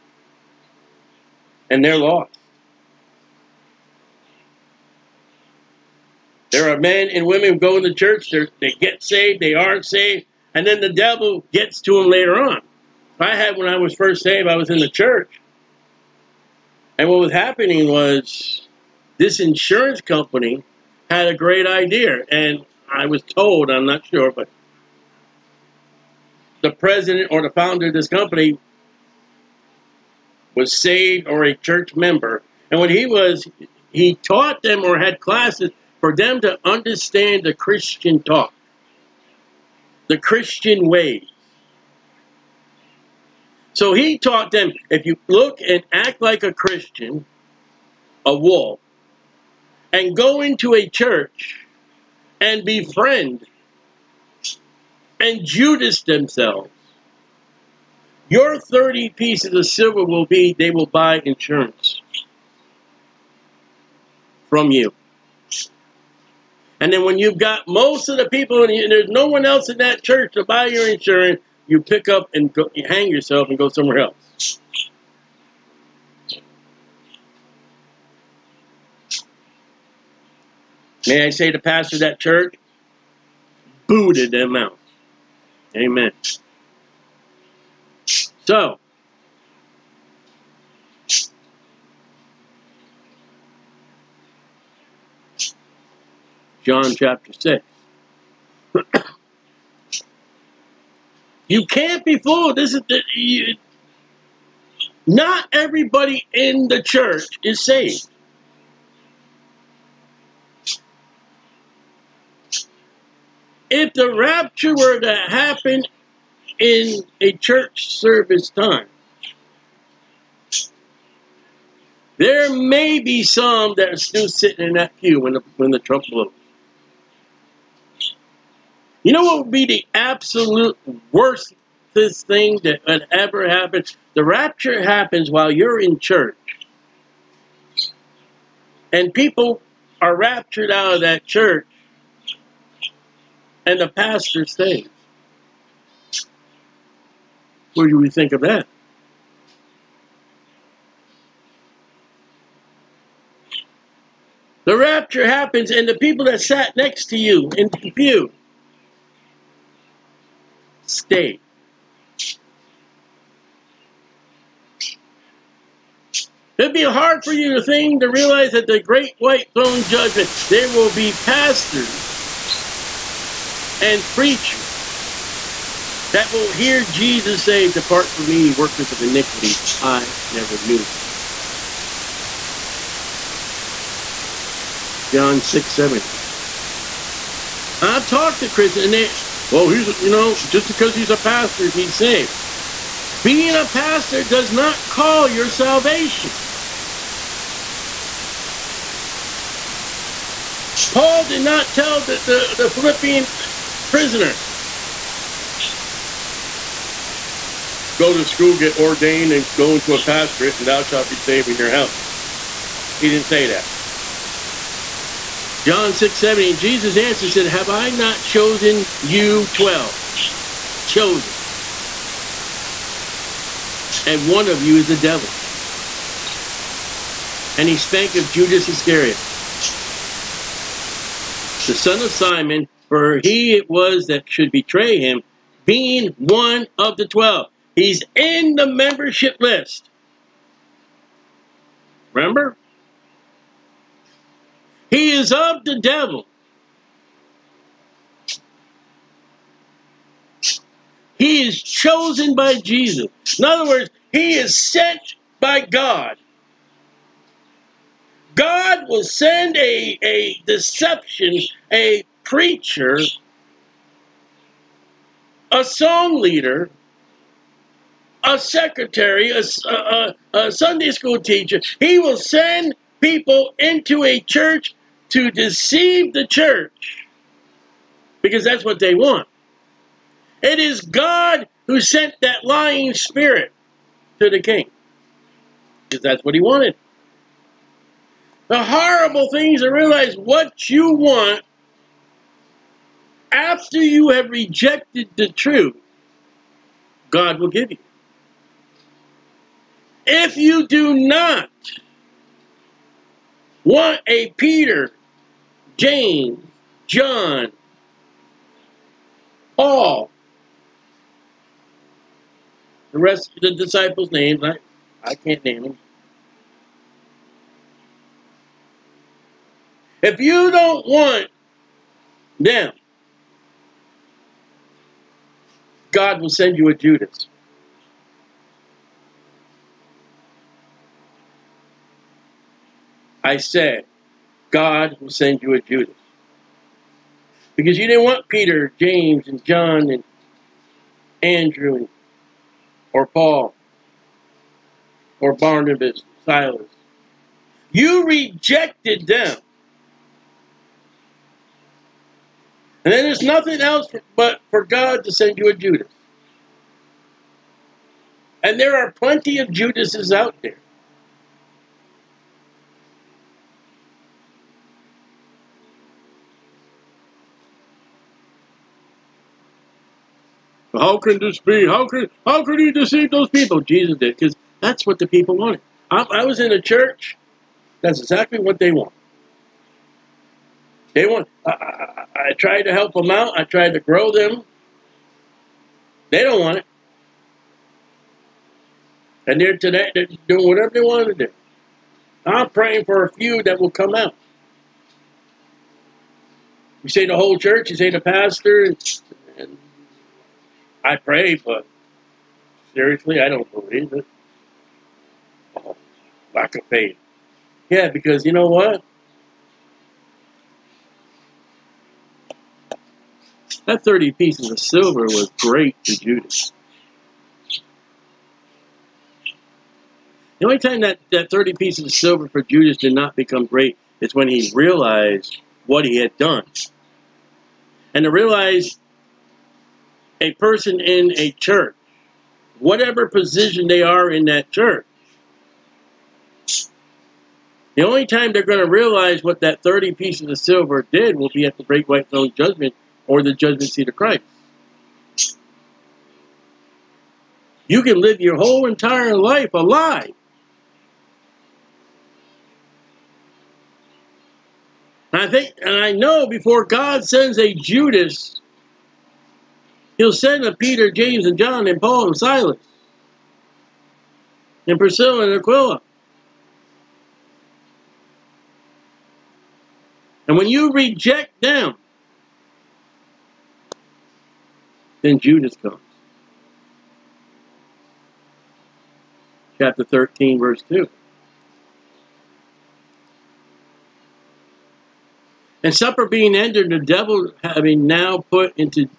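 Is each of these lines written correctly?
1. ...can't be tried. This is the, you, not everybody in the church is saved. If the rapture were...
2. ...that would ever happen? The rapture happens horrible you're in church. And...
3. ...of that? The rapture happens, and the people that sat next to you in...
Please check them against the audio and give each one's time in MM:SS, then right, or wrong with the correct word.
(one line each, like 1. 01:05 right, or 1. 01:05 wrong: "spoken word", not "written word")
1. 01:41 wrong: "fooled", not "tried"
2. 02:12 wrong: "while", not "horrible"
3. 02:28 right.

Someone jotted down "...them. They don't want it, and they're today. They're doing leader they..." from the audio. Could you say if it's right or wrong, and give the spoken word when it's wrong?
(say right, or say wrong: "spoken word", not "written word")
wrong: "whatever", not "leader".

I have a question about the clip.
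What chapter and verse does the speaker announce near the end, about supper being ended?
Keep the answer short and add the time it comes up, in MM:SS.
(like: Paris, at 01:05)
Chapter 13, verse 2, at 07:59.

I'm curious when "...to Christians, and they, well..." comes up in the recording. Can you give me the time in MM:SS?
03:08.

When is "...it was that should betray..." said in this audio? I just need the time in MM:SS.
03:53.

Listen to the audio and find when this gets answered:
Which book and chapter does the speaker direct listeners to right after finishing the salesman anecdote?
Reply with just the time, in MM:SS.
01:36.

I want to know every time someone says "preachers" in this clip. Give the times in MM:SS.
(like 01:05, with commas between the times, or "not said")
02:54, 04:22.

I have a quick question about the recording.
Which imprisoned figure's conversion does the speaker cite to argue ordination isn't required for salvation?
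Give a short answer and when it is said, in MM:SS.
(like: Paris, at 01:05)
The Philippian prisoner, at 03:22.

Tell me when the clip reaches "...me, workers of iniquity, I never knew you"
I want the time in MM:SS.
02:58.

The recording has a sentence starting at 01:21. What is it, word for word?
May I say the pastor of that church booted them out.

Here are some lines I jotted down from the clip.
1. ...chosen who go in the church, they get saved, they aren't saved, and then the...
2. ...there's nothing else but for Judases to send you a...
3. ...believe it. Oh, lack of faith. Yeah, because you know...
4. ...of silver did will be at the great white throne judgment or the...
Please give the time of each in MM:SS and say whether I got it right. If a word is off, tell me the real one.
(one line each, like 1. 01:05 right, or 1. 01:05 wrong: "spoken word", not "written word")
1. 00:07 wrong: "women", not "chosen"
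2. 05:53 wrong: "God", not "Judases"
3. 06:43 right
4. 07:20 right.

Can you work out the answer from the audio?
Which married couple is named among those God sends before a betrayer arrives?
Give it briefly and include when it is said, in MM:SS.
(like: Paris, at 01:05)
Priscilla and Aquila, at 07:44.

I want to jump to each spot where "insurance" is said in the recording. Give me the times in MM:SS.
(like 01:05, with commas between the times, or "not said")
00:19, 01:01, 01:10.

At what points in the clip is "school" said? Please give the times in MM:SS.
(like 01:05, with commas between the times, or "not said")
03:28, 04:30.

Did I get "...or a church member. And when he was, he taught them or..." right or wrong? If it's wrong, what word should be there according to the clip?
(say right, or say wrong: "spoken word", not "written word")
right.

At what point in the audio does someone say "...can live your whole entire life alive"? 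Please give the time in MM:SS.
07:27.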